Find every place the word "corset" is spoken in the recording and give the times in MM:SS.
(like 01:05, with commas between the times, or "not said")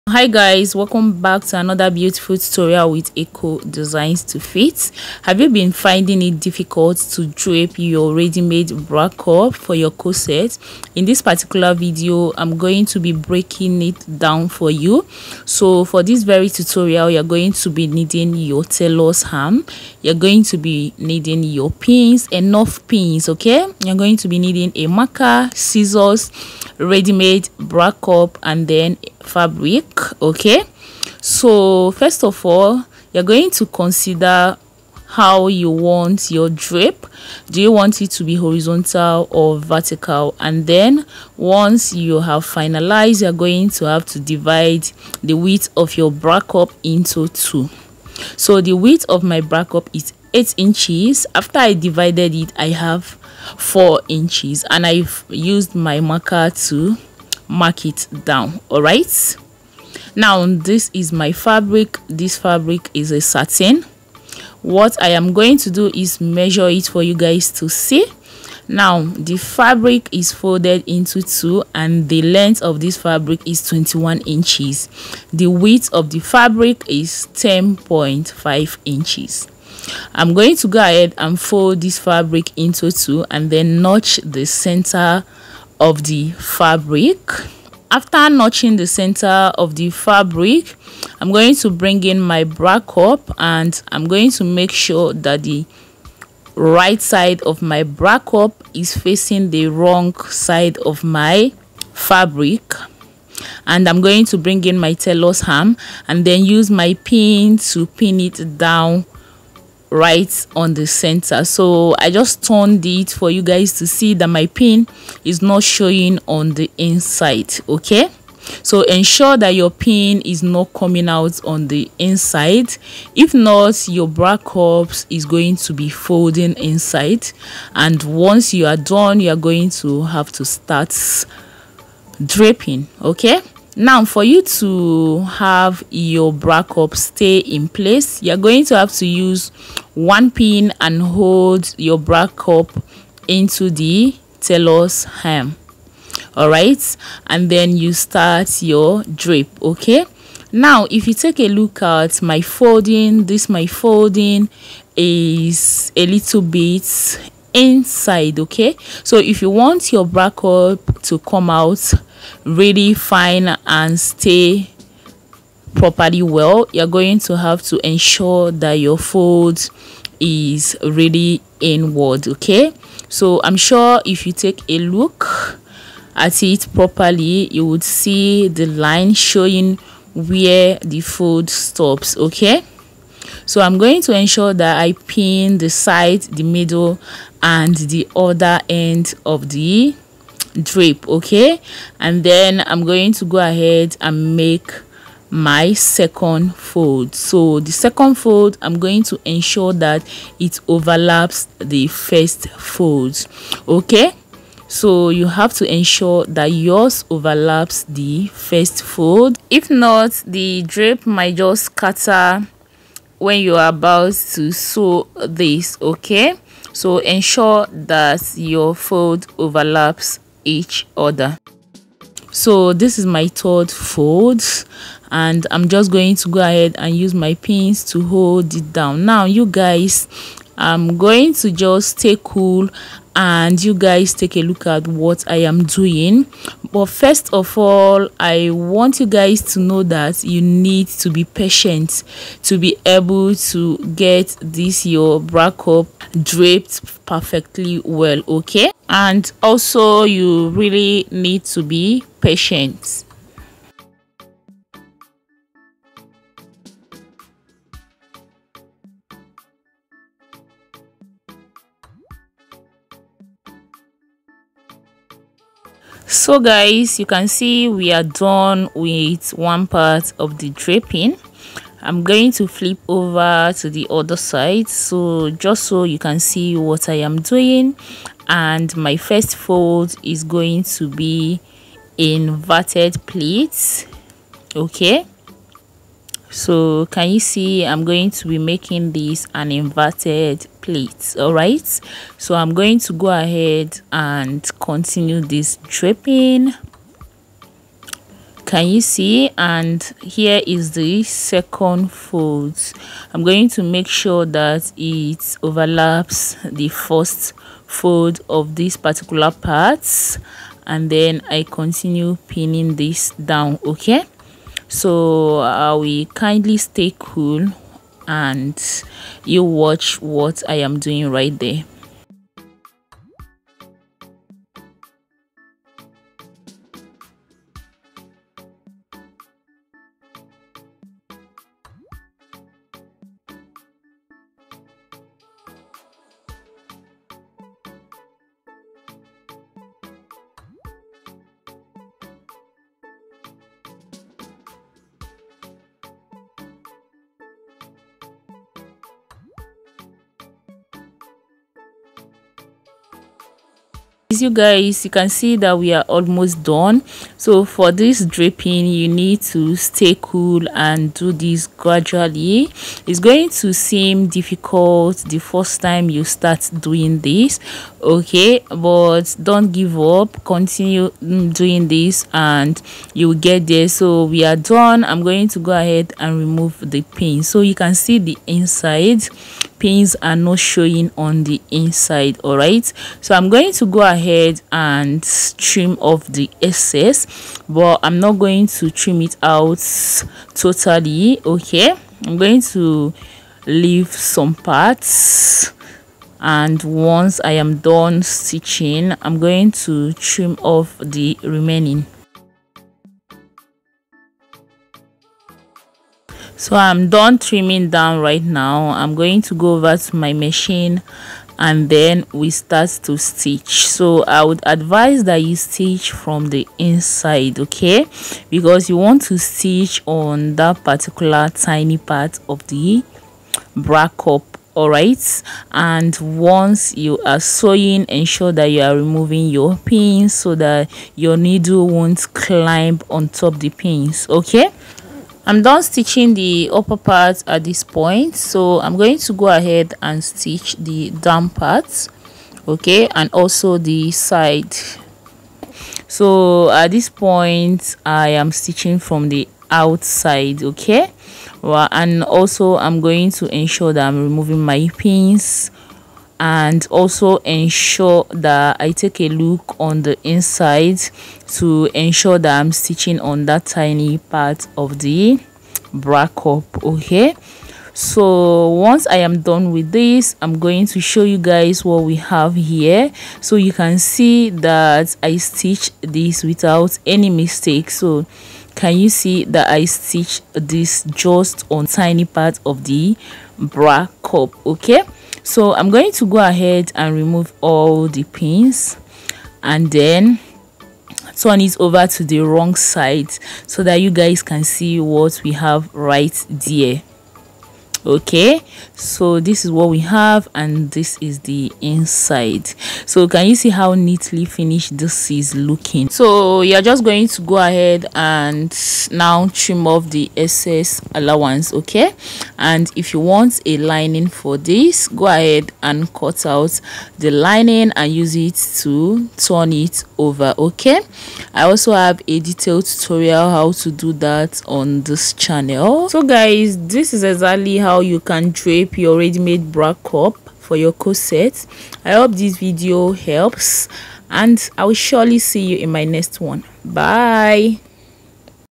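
00:09, 08:50.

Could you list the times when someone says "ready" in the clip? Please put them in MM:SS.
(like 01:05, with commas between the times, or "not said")
00:08, 00:26, 08:48.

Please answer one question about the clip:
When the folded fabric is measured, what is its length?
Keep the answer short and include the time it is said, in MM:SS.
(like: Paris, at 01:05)
21 inches, at 01:13.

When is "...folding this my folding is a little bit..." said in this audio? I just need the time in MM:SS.
02:32.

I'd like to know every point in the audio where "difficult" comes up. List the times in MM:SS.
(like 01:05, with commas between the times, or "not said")
00:06, 06:04.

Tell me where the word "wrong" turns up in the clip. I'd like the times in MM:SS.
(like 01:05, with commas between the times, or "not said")
01:39, 08:12.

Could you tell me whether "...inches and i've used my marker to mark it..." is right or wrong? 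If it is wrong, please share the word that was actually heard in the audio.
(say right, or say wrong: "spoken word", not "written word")
right.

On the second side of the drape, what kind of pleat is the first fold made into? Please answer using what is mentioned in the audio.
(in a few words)
inverted pleat.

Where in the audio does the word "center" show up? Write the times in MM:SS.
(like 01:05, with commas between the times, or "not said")
01:24, 01:28, 01:50.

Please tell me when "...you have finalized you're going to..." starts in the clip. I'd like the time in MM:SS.
00:41.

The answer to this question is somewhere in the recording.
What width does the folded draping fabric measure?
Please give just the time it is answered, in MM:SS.
01:17.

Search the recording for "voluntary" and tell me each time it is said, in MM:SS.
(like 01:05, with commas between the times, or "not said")
not said.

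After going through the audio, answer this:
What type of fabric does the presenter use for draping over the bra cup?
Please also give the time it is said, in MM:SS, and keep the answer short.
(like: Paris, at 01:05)
satin, at 01:03.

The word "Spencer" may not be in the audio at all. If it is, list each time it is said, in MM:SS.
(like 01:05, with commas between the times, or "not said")
not said.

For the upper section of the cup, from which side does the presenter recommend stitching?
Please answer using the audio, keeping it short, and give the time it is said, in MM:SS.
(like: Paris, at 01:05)
from the inside, at 06:55.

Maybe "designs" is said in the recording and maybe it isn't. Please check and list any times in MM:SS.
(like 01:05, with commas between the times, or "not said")
00:03.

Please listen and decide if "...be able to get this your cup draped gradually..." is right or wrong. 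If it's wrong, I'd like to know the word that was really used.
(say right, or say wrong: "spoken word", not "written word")
wrong: "perfectly", not "gradually".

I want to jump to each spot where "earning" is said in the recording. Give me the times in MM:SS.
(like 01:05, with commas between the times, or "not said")
not said.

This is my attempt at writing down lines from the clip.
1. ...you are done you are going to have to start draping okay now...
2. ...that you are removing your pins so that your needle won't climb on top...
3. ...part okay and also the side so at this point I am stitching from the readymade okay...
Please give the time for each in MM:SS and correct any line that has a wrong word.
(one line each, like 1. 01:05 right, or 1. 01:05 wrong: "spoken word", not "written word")
1. 02:08 right
2. 07:08 right
3. 07:21 wrong: "outside", not "readymade".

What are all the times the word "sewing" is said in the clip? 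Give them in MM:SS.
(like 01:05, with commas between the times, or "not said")
07:07.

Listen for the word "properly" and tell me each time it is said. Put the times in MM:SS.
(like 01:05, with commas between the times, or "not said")
02:45, 02:56.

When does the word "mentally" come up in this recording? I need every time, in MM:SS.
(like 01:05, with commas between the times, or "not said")
not said.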